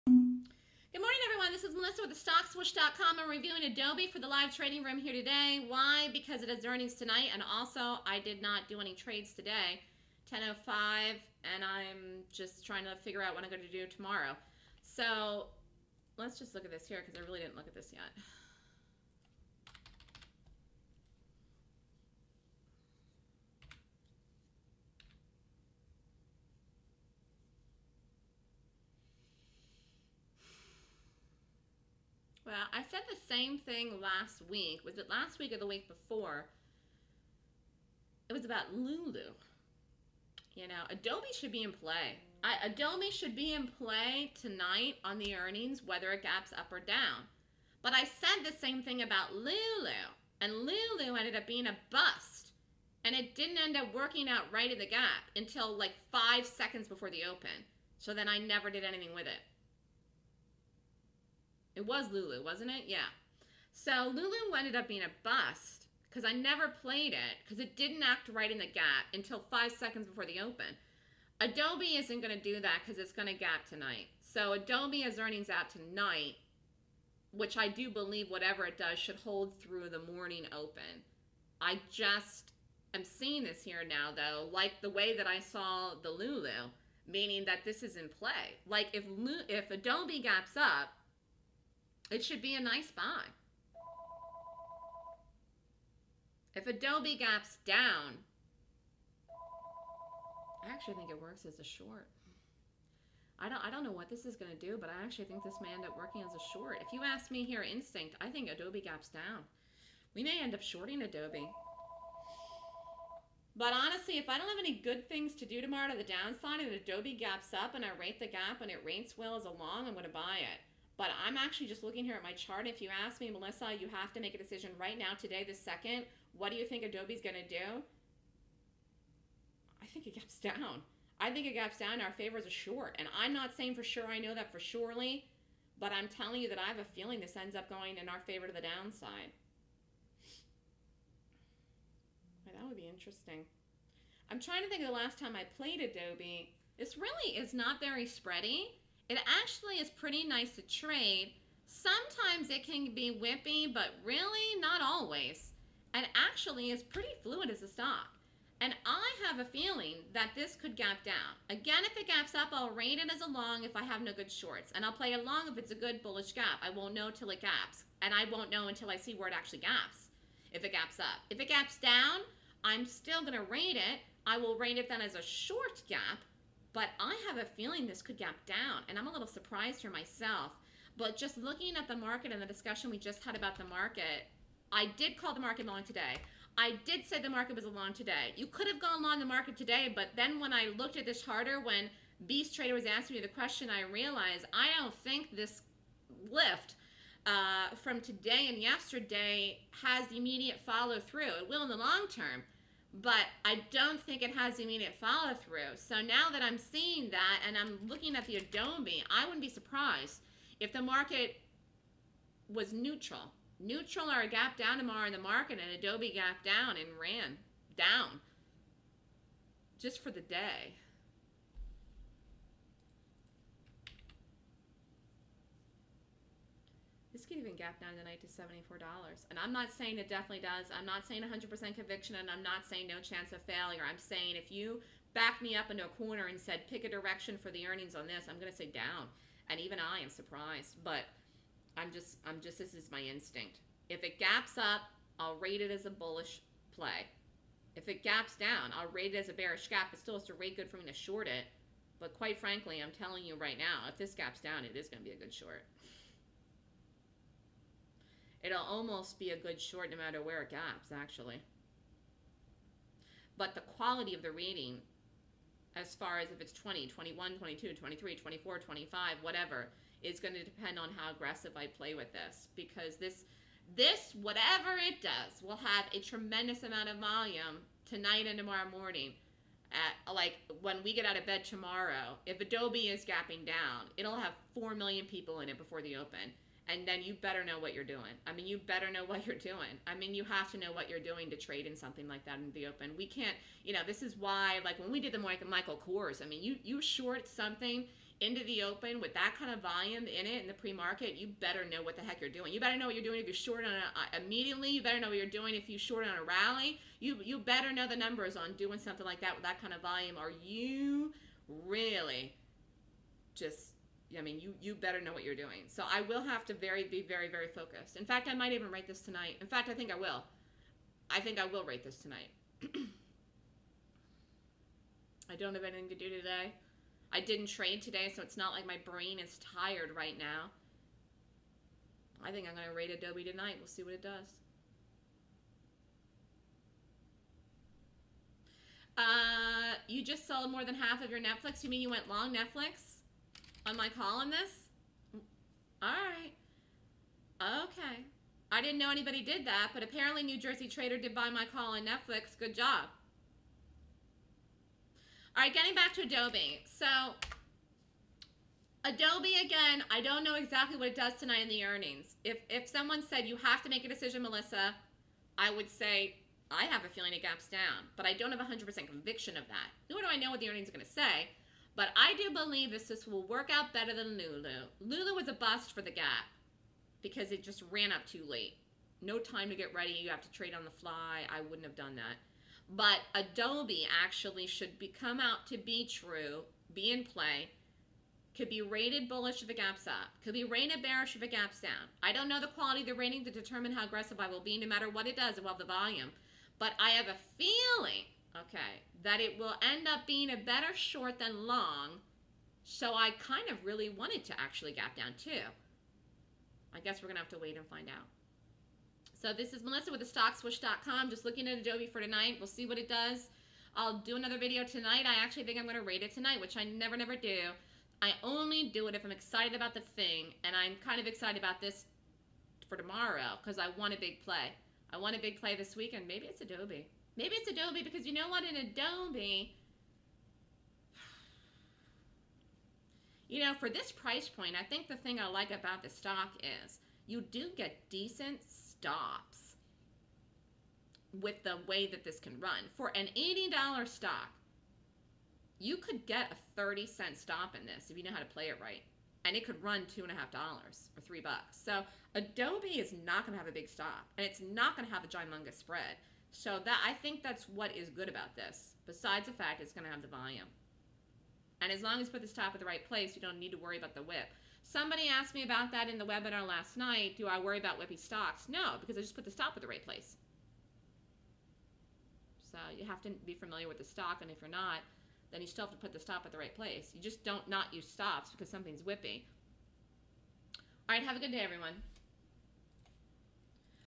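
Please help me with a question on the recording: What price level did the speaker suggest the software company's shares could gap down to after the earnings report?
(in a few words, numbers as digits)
$74.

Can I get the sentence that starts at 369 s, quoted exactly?
Nor do I know what the earnings are going to say.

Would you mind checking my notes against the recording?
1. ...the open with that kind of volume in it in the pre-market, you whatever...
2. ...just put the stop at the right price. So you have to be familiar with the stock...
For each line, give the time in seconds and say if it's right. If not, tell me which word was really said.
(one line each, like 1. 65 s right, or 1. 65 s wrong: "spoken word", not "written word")
1. 298 s wrong: "better", not "whatever"
2. 469 s wrong: "place", not "price".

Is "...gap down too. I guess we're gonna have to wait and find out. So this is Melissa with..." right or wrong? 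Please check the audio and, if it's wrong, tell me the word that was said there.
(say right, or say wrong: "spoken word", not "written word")
right.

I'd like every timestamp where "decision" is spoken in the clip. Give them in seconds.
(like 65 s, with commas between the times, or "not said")
124 s, 363 s.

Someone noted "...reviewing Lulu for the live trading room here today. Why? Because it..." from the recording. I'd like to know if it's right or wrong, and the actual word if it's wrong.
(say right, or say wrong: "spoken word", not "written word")
wrong: "Adobe", not "Lulu".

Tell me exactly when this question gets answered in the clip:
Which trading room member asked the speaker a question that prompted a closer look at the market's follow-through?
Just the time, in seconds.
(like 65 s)
192 s.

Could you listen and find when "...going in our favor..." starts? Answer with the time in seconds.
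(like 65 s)
137 s.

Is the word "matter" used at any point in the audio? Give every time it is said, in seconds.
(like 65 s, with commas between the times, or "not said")
259 s, 394 s.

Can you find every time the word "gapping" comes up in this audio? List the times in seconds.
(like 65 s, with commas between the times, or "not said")
283 s.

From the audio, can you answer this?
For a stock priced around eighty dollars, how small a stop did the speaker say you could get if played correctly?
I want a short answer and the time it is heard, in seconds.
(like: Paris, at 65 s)
30 cents, at 446 s.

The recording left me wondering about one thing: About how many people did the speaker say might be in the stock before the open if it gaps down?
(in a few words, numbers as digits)
4 million.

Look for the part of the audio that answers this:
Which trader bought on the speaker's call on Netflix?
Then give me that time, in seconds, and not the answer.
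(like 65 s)
350 s.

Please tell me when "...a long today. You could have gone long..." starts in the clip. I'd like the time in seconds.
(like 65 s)
187 s.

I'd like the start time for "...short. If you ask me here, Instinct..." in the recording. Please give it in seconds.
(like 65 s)
106 s.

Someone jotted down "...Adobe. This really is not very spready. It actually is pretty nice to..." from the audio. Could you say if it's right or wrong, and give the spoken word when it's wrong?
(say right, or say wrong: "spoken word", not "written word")
right.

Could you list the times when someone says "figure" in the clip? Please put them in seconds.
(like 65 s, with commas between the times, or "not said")
13 s.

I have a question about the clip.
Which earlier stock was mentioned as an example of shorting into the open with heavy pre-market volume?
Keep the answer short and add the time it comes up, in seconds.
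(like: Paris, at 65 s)
Michael Kors, at 295 s.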